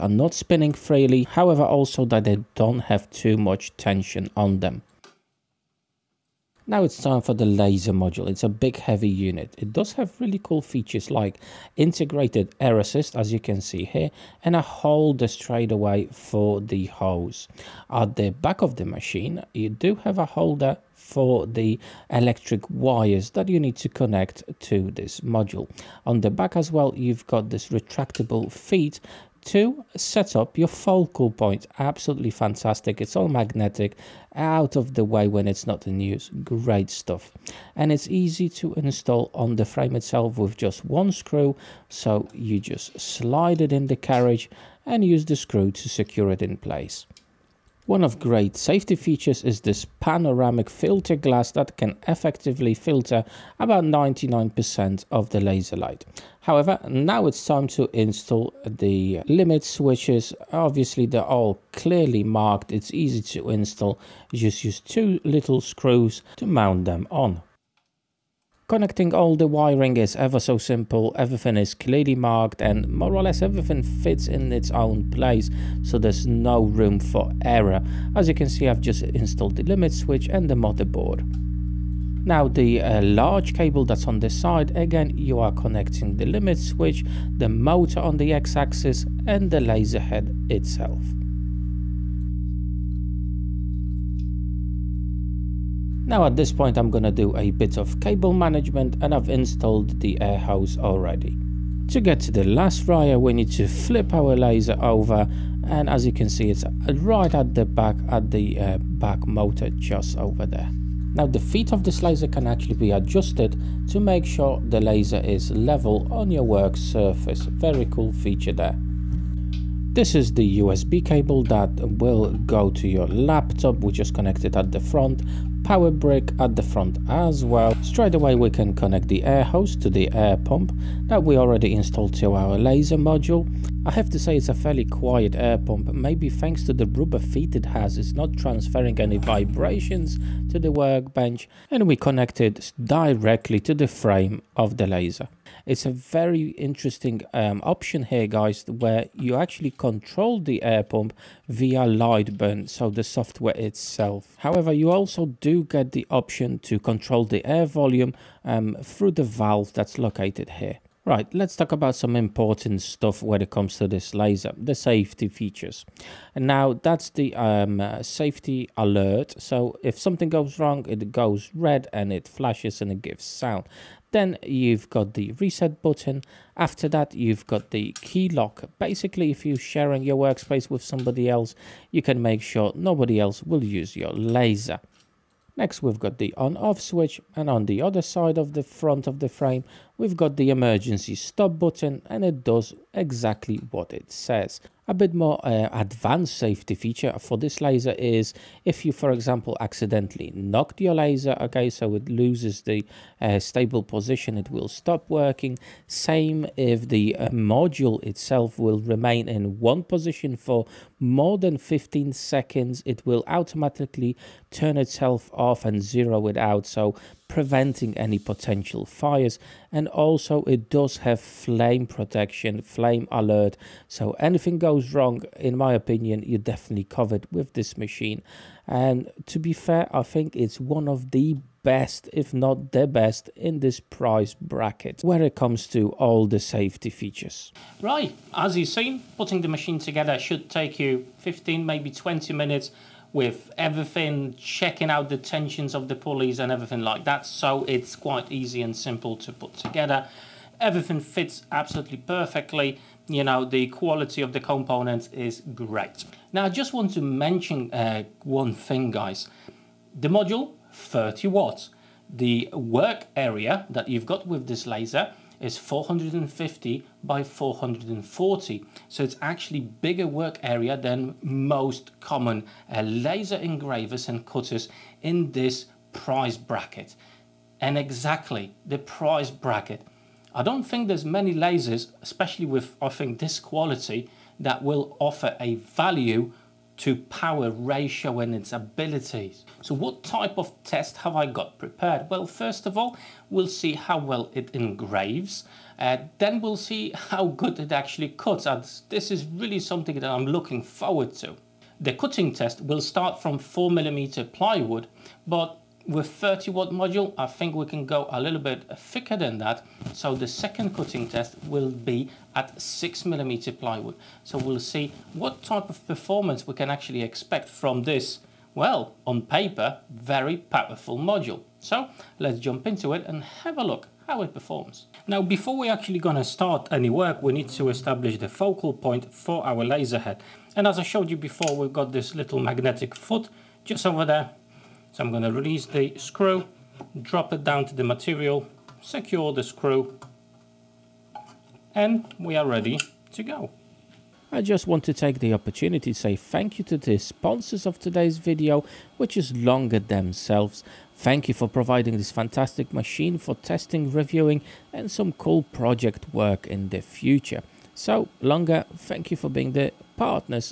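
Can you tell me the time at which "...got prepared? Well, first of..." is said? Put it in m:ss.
4:51.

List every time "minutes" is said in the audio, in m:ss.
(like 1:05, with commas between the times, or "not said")
4:02.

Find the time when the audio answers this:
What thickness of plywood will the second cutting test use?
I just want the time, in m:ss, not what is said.
5:12.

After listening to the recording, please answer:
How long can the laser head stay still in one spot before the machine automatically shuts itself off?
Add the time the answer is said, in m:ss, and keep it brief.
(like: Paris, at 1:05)
15 seconds, at 3:31.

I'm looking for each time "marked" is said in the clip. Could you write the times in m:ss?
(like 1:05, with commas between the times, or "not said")
1:02, 1:12.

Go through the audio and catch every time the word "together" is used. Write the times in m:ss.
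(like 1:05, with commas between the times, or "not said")
3:59, 4:09.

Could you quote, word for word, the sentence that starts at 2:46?
And now that's the um, uh, safety alert.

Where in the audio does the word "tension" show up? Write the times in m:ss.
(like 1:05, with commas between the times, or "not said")
0:03, 4:05.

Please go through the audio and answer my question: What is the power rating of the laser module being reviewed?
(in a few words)
30 watts.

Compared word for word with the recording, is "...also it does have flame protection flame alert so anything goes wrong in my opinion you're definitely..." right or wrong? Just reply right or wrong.
right.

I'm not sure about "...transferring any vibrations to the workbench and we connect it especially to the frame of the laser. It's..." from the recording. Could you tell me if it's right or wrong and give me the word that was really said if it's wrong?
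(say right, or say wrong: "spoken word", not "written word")
wrong: "directly", not "especially".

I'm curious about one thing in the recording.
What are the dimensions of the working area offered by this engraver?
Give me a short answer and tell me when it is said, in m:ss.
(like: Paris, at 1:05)
450 by 440, at 4:25.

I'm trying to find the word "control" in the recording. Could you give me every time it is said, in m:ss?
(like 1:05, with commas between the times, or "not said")
2:29, 2:36.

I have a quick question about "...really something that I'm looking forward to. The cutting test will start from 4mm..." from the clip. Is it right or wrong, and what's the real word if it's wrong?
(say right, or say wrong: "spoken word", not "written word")
right.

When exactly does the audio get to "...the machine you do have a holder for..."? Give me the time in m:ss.
0:18.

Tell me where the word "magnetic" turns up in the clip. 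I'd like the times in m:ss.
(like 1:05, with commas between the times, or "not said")
0:33, 5:32.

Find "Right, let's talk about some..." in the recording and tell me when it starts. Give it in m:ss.
2:41.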